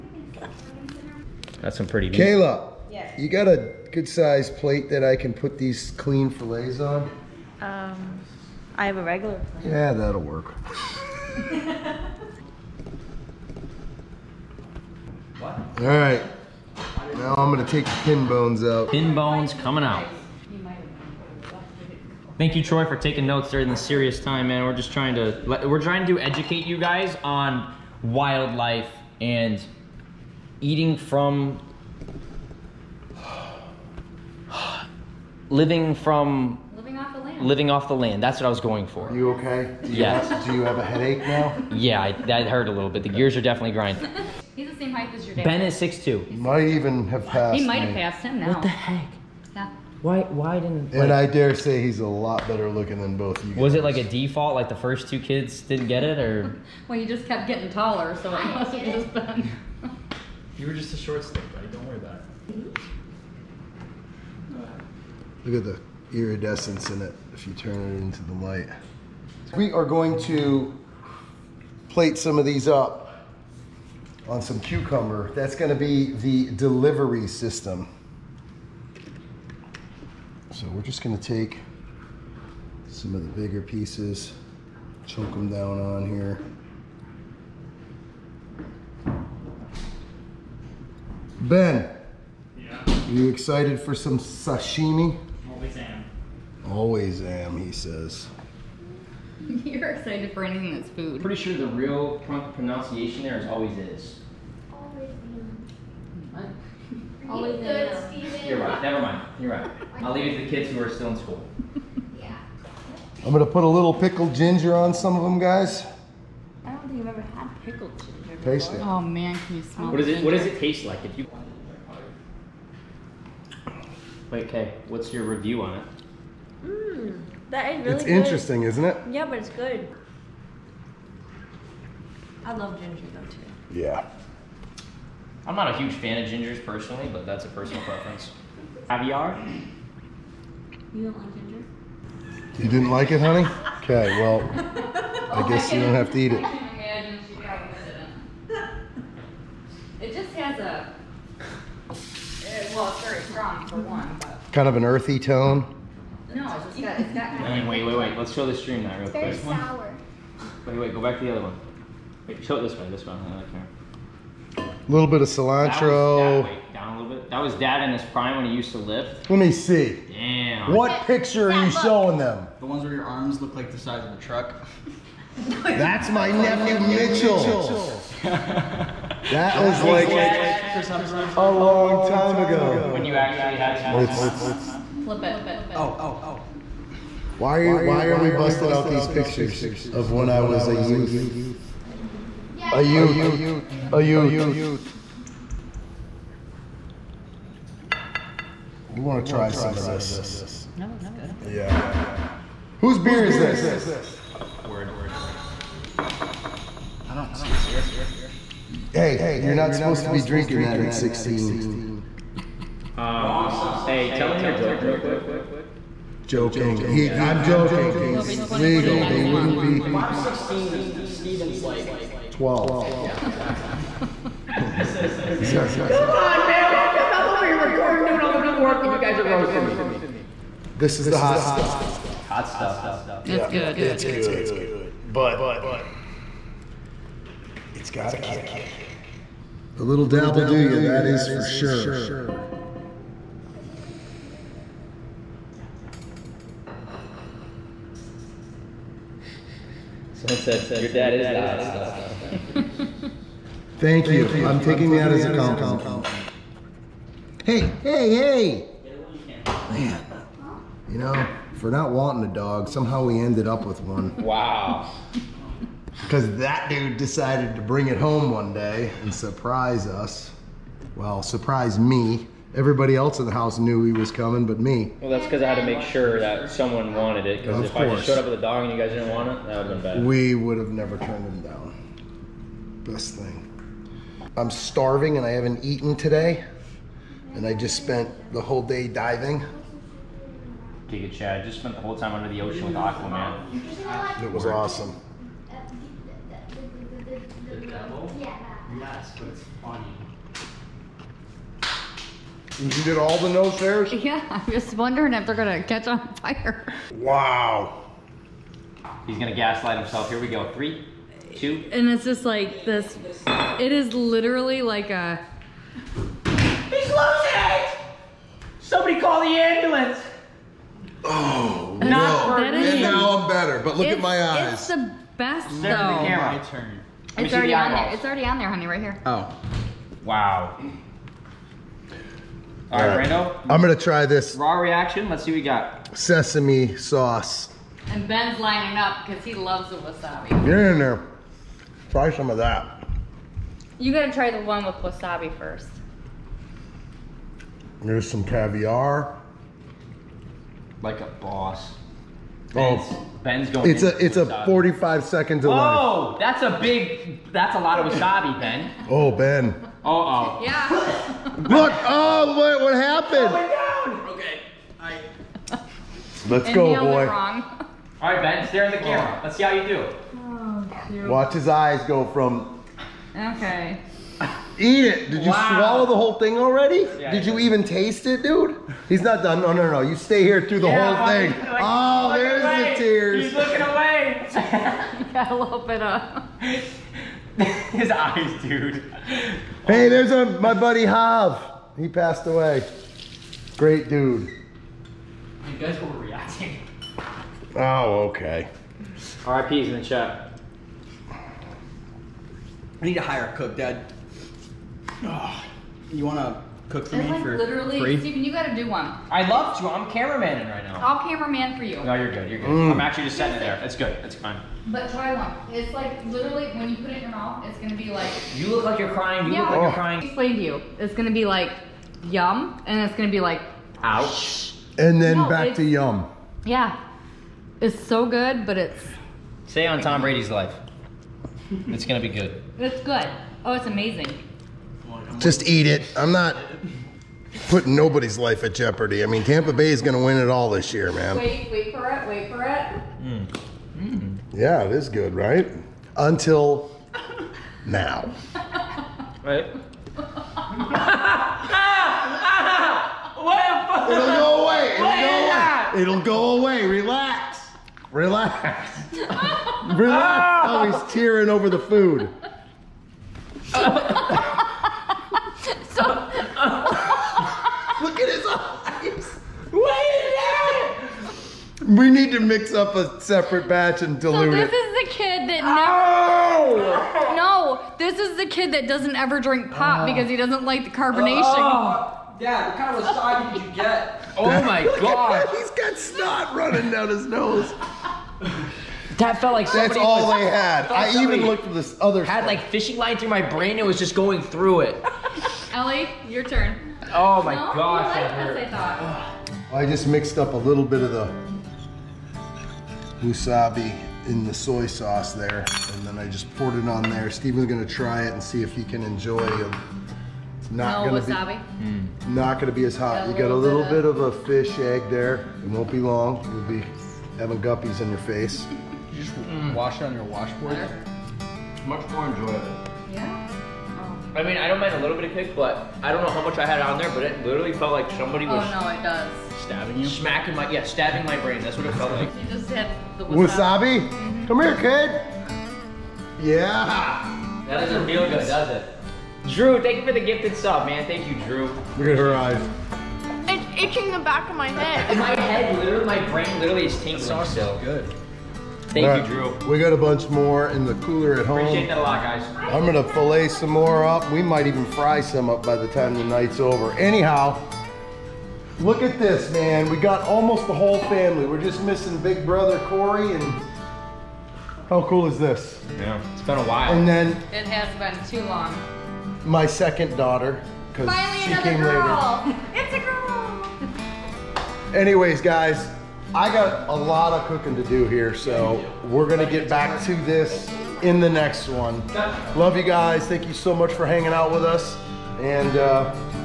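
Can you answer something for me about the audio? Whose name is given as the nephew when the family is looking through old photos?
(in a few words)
Mitchell.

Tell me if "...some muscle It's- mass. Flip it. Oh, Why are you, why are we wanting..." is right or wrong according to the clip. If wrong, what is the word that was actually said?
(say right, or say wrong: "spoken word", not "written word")
wrong: "busting", not "wanting".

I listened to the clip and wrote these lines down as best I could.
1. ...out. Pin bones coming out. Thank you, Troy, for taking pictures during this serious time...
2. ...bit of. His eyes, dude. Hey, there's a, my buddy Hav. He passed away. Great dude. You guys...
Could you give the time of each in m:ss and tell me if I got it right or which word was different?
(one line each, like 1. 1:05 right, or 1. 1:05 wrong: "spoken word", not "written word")
1. 0:18 wrong: "notes", not "pictures"
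2. 6:25 right.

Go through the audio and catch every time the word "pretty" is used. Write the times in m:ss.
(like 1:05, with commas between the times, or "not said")
0:01, 1:41.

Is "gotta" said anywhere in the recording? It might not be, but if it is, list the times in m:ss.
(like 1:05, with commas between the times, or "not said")
5:43, 6:48.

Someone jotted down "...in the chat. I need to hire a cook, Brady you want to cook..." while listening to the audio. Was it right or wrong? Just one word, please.
wrong.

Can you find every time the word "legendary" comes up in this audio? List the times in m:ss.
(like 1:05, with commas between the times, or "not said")
not said.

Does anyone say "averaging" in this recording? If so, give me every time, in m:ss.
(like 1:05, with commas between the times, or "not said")
not said.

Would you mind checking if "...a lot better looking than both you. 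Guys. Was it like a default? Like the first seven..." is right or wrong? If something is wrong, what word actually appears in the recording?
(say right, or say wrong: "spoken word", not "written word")
wrong: "two", not "seven".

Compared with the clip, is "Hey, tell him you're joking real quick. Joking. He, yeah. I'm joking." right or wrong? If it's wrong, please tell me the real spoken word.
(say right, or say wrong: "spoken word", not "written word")
right.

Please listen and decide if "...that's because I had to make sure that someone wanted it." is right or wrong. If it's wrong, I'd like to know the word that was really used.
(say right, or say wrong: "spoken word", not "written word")
right.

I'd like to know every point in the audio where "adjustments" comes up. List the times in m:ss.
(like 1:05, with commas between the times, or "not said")
not said.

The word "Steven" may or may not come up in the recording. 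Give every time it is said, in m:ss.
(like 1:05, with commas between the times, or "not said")
3:41, 8:27.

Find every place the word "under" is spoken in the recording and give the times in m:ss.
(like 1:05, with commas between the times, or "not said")
4:52.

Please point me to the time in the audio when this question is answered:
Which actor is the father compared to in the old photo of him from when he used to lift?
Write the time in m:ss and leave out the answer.
3:00.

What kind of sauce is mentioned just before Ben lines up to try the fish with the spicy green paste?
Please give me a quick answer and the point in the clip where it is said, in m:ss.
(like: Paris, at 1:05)
Sesame sauce, at 5:35.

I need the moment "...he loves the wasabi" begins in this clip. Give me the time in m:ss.
5:39.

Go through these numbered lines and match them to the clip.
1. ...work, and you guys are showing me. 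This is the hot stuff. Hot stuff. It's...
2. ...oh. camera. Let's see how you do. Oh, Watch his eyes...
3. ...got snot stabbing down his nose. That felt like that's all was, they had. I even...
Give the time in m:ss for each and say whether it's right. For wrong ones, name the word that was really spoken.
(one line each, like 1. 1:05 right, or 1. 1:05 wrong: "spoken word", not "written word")
1. 3:48 wrong: "roasting", not "showing"
2. 6:08 right
3. 8:05 wrong: "running", not "stabbing".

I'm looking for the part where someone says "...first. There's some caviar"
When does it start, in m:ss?
5:45.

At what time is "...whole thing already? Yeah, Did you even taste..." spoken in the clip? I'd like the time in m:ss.
6:15.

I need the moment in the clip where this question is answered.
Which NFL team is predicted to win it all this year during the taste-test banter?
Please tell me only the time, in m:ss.
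7:19.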